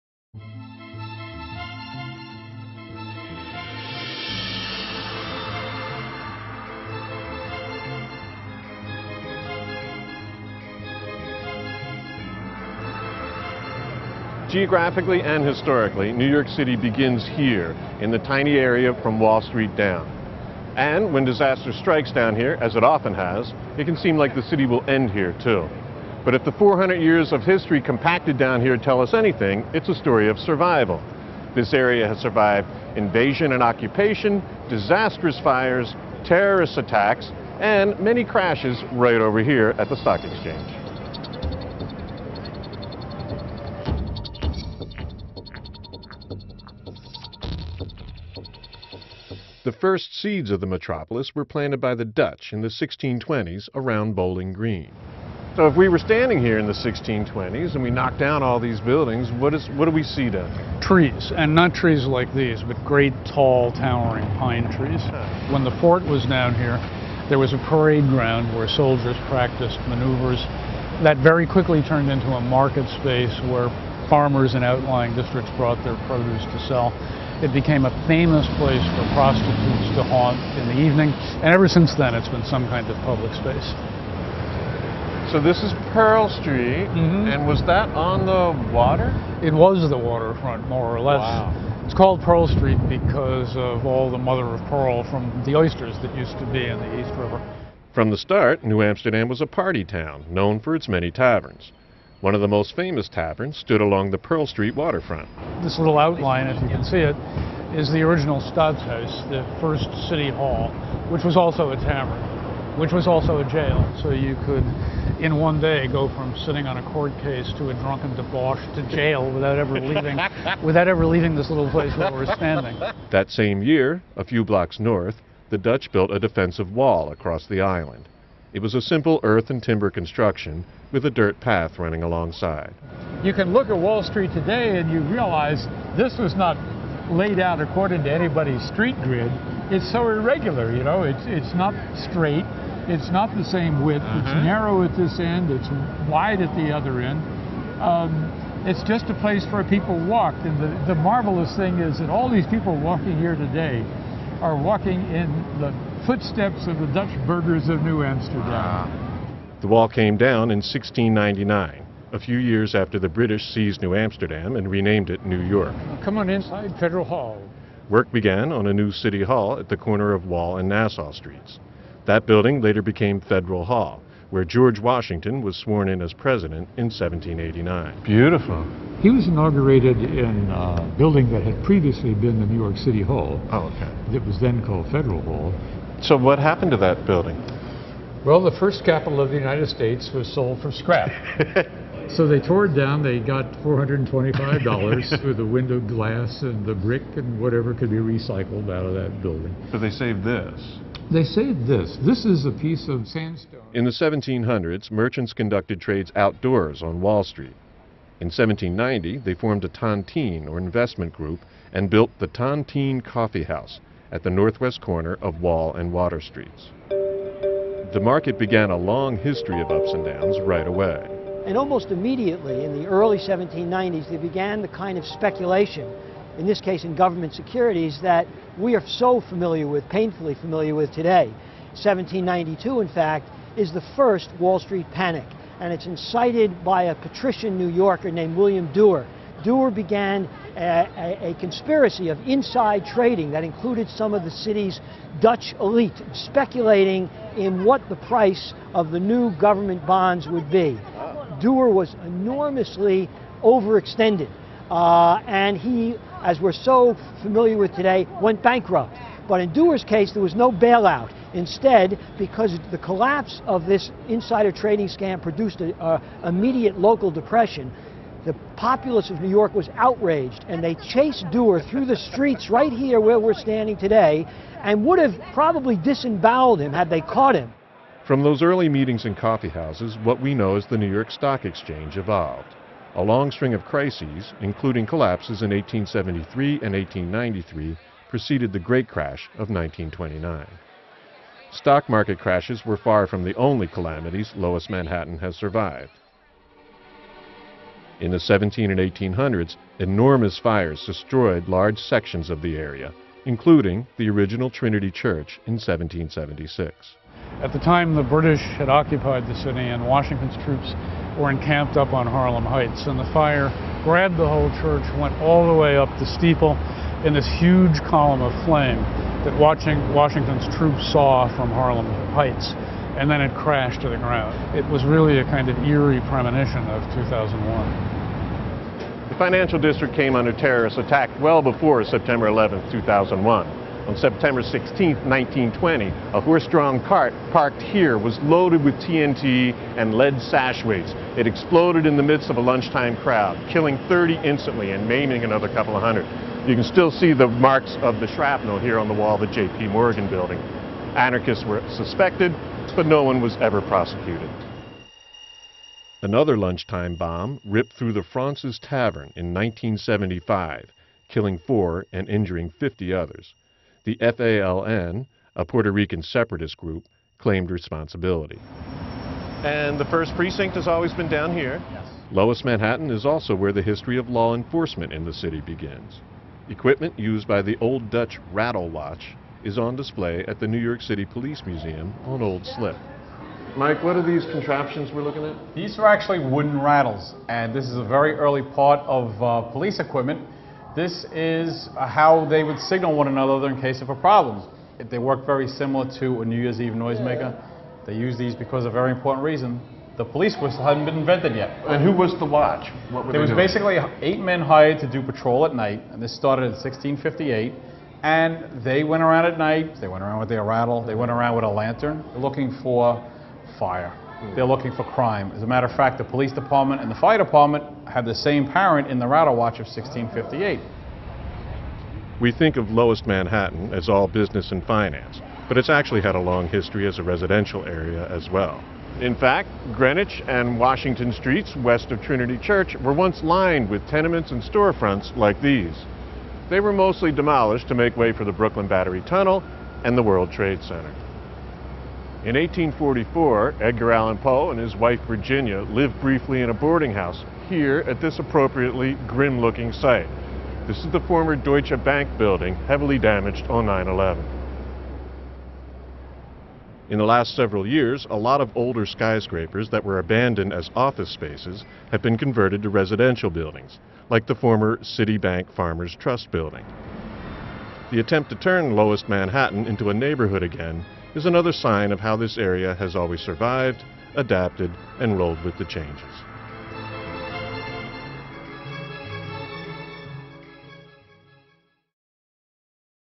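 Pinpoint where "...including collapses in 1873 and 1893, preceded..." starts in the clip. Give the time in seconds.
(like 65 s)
284 s.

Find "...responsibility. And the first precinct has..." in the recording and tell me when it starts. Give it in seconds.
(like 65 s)
367 s.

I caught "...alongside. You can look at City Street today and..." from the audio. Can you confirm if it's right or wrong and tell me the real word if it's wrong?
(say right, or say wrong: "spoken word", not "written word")
wrong: "Wall", not "City".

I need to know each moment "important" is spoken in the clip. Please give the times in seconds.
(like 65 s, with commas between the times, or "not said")
398 s.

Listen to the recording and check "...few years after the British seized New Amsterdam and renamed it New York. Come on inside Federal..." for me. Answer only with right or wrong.
right.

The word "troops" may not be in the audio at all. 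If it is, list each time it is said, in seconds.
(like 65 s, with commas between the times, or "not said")
310 s, 320 s.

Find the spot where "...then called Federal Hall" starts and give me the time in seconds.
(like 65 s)
184 s.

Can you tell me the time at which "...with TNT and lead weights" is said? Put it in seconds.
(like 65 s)
338 s.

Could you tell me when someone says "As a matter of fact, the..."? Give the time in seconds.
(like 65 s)
415 s.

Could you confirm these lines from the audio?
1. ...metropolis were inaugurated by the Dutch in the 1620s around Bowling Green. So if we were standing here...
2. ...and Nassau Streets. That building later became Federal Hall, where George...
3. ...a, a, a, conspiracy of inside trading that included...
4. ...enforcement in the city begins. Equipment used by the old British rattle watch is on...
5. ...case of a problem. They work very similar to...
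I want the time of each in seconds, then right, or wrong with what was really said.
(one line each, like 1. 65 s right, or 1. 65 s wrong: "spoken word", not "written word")
1. 50 s wrong: "planted", not "inaugurated"
2. 170 s right
3. 240 s right
4. 374 s wrong: "Dutch", not "British"
5. 393 s right.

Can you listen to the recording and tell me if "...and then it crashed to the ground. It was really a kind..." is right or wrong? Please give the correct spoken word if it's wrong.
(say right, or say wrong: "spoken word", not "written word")
right.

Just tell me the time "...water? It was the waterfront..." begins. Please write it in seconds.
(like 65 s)
88 s.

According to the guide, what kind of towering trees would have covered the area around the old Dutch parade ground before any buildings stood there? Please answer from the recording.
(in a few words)
pine trees.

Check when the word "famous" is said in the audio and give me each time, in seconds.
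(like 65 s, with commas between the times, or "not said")
78 s, 102 s.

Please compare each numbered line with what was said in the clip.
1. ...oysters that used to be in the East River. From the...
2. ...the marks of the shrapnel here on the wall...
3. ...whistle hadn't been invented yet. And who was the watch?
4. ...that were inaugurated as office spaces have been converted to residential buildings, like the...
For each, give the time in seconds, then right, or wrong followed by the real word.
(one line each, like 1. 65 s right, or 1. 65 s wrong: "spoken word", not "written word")
1. 95 s right
2. 347 s right
3. 400 s right
4. 459 s wrong: "abandoned", not "inaugurated".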